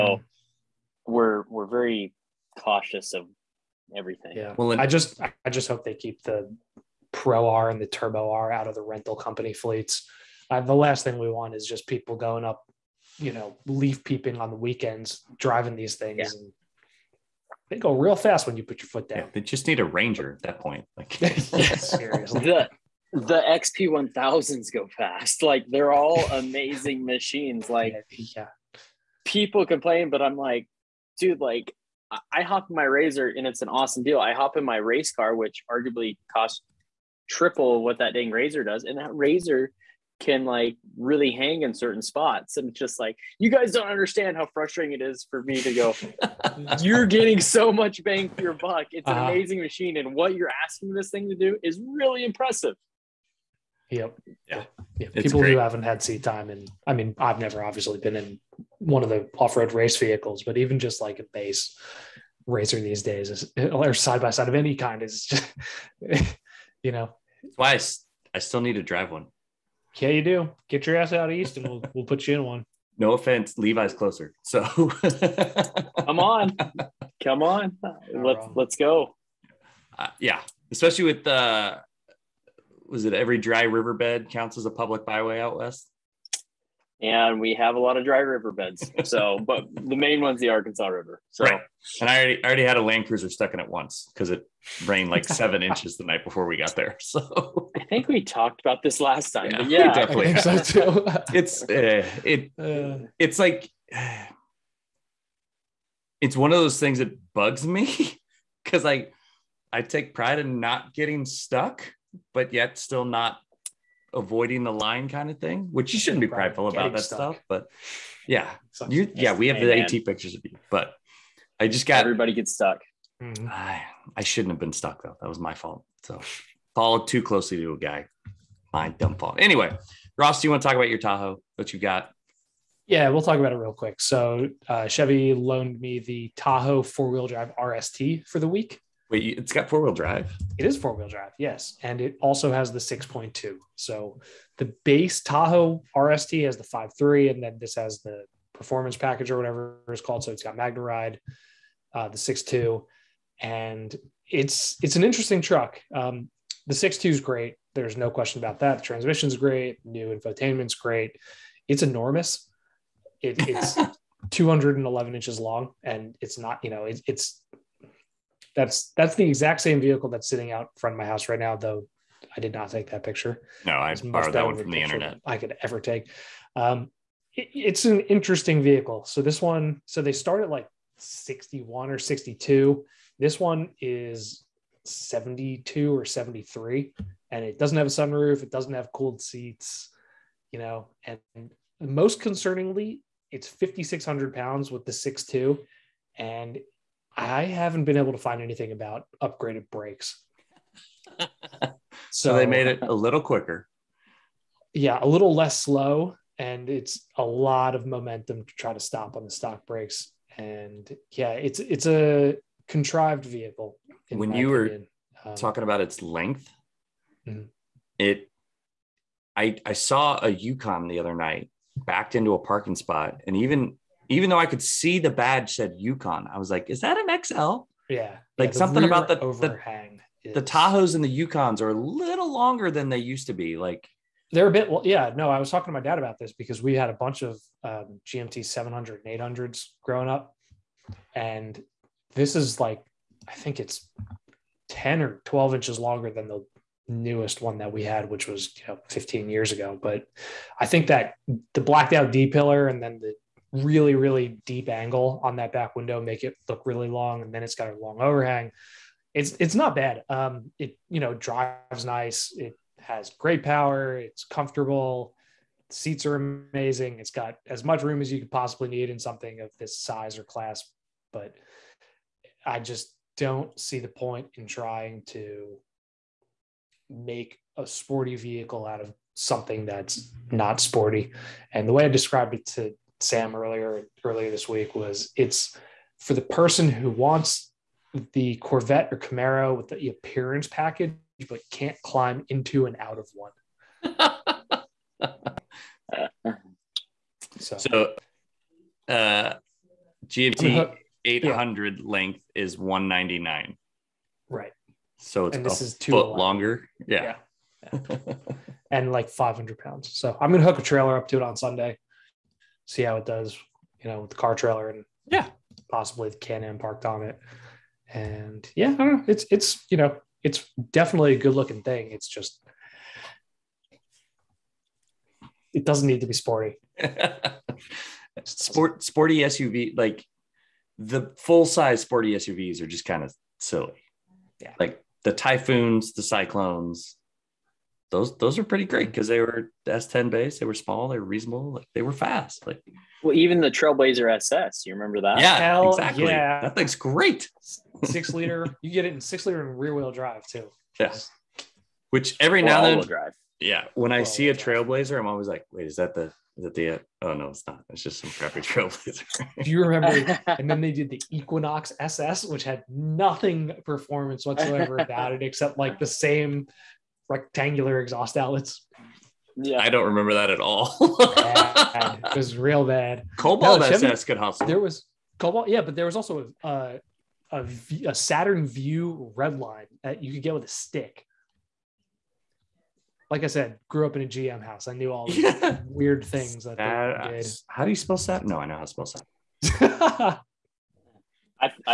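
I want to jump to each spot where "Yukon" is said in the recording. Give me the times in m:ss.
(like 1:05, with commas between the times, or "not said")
3:40, 3:45, 3:51.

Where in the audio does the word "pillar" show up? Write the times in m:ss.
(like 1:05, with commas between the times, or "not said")
4:12.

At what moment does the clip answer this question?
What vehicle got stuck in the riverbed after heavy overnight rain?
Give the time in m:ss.
1:32.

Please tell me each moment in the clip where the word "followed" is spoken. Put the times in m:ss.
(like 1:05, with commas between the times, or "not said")
2:06.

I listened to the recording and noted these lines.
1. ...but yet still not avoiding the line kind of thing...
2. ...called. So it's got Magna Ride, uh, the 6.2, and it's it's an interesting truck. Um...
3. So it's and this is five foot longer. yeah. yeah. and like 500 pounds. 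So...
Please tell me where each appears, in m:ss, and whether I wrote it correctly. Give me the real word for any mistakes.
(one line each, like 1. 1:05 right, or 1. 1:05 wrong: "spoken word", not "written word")
1. 1:52 right
2. 2:30 right
3. 5:04 wrong: "two", not "five".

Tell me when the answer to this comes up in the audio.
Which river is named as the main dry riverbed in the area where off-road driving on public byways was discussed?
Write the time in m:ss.
1:30.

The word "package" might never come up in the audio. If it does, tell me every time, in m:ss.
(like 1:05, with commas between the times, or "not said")
2:28, 4:50.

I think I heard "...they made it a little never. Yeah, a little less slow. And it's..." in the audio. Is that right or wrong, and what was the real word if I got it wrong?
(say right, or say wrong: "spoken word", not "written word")
wrong: "quicker", not "never".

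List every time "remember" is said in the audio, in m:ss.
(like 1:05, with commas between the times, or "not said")
5:44, 5:59, 6:09.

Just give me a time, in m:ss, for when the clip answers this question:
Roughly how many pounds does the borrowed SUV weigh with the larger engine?
3:13.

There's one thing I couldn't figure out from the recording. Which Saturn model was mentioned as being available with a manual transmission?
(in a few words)
Vue Redline.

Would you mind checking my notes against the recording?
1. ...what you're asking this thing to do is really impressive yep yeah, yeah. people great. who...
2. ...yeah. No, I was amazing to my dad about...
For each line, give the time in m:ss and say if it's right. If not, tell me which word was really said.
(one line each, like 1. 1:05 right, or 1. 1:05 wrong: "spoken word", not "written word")
1. 0:50 right
2. 3:54 wrong: "talking", not "amazing".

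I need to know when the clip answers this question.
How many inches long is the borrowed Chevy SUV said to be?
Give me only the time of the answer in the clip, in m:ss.
2:44.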